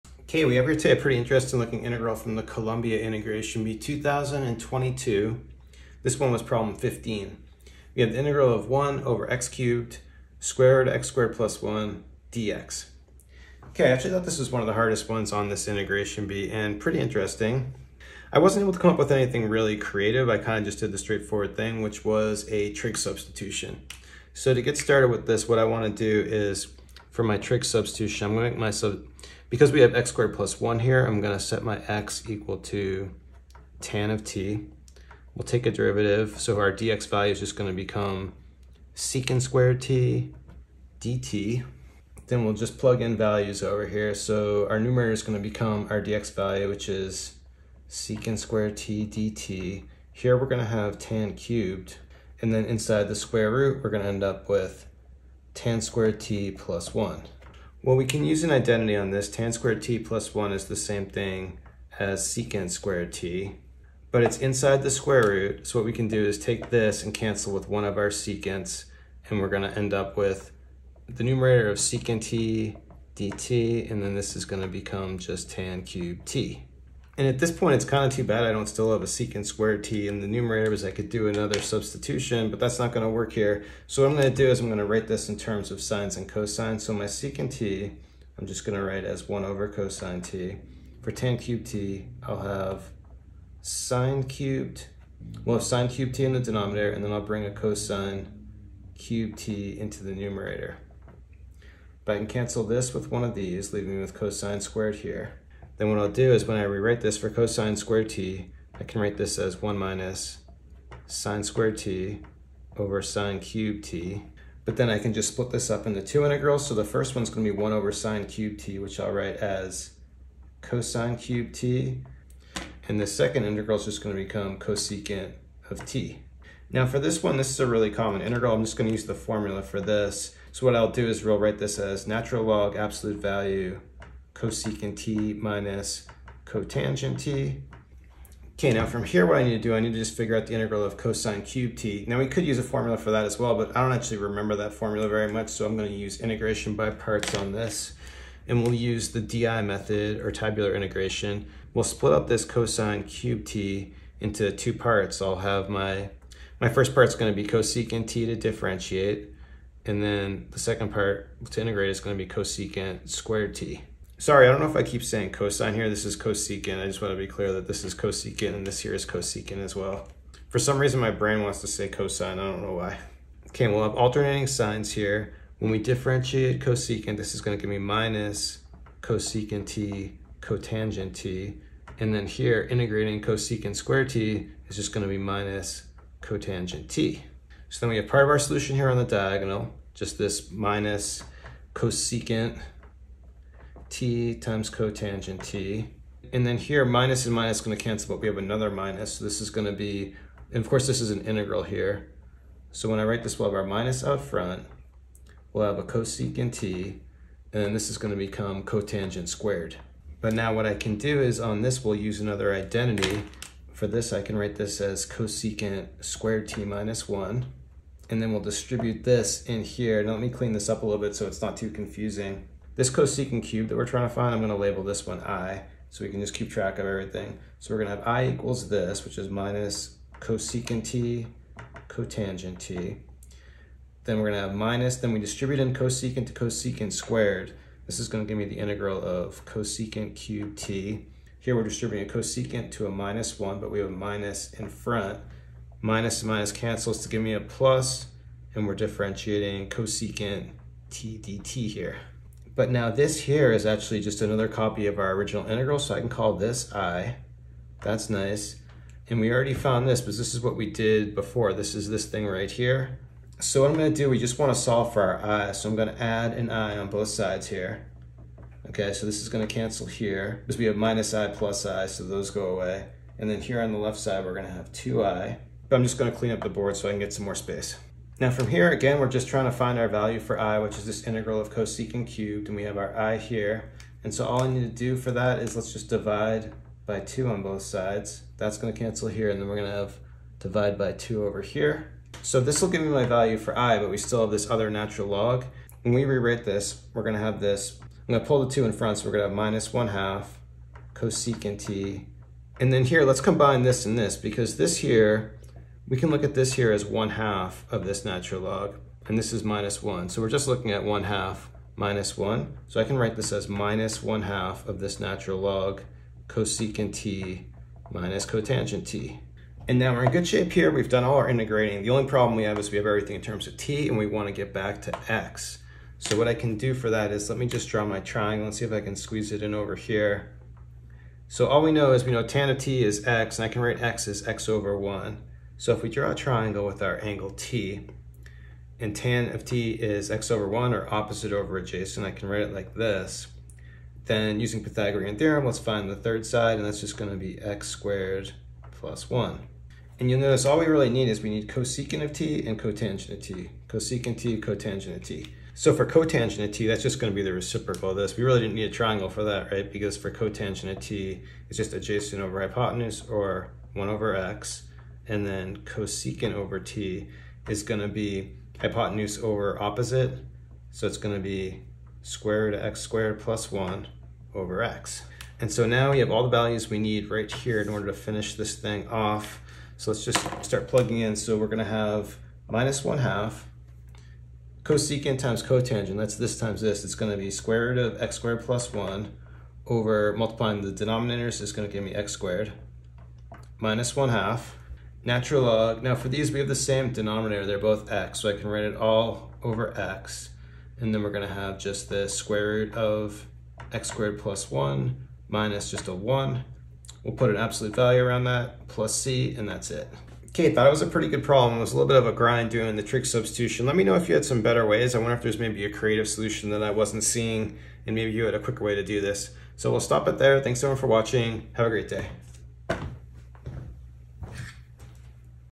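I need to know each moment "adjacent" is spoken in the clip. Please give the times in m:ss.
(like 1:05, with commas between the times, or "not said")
5:41, 6:01.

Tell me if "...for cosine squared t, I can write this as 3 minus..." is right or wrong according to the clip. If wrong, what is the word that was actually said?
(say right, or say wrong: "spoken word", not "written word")
wrong: "1", not "3".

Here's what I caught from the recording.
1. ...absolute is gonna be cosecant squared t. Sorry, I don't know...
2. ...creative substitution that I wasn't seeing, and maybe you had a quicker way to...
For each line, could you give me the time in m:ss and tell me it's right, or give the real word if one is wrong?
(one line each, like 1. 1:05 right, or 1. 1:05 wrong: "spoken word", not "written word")
1. 2:41 wrong: "integrate", not "absolute"
2. 6:55 wrong: "solution", not "substitution".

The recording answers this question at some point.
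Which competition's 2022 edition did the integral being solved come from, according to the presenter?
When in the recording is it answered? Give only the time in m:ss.
0:02.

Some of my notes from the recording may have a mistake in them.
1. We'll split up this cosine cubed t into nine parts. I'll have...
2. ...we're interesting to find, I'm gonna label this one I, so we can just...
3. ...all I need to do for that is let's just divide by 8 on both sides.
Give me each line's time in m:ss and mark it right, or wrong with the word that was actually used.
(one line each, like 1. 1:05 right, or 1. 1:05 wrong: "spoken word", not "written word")
1. 2:31 wrong: "two", not "nine"
2. 3:43 wrong: "trying", not "interesting"
3. 4:44 wrong: "2", not "8".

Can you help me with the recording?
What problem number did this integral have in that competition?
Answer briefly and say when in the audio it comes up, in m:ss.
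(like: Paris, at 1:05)
15, at 0:06.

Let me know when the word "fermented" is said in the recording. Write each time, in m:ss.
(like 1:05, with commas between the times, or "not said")
not said.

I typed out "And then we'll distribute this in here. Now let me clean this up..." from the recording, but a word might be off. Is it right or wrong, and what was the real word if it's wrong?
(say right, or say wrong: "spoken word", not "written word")
right.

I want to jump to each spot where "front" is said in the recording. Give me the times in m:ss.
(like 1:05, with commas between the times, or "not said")
3:24, 4:04, 4:58.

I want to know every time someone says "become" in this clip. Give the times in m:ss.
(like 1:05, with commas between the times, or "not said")
0:37, 0:45, 1:14, 2:04, 3:28.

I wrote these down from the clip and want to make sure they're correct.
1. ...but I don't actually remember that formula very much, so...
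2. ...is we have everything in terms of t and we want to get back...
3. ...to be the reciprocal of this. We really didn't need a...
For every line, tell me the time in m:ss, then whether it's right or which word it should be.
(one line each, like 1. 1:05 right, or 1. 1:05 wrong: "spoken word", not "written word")
1. 2:23 right
2. 5:22 right
3. 5:57 right.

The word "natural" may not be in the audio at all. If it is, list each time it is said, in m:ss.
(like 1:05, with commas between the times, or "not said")
2:12, 4:54, 5:08, 5:15, 6:35.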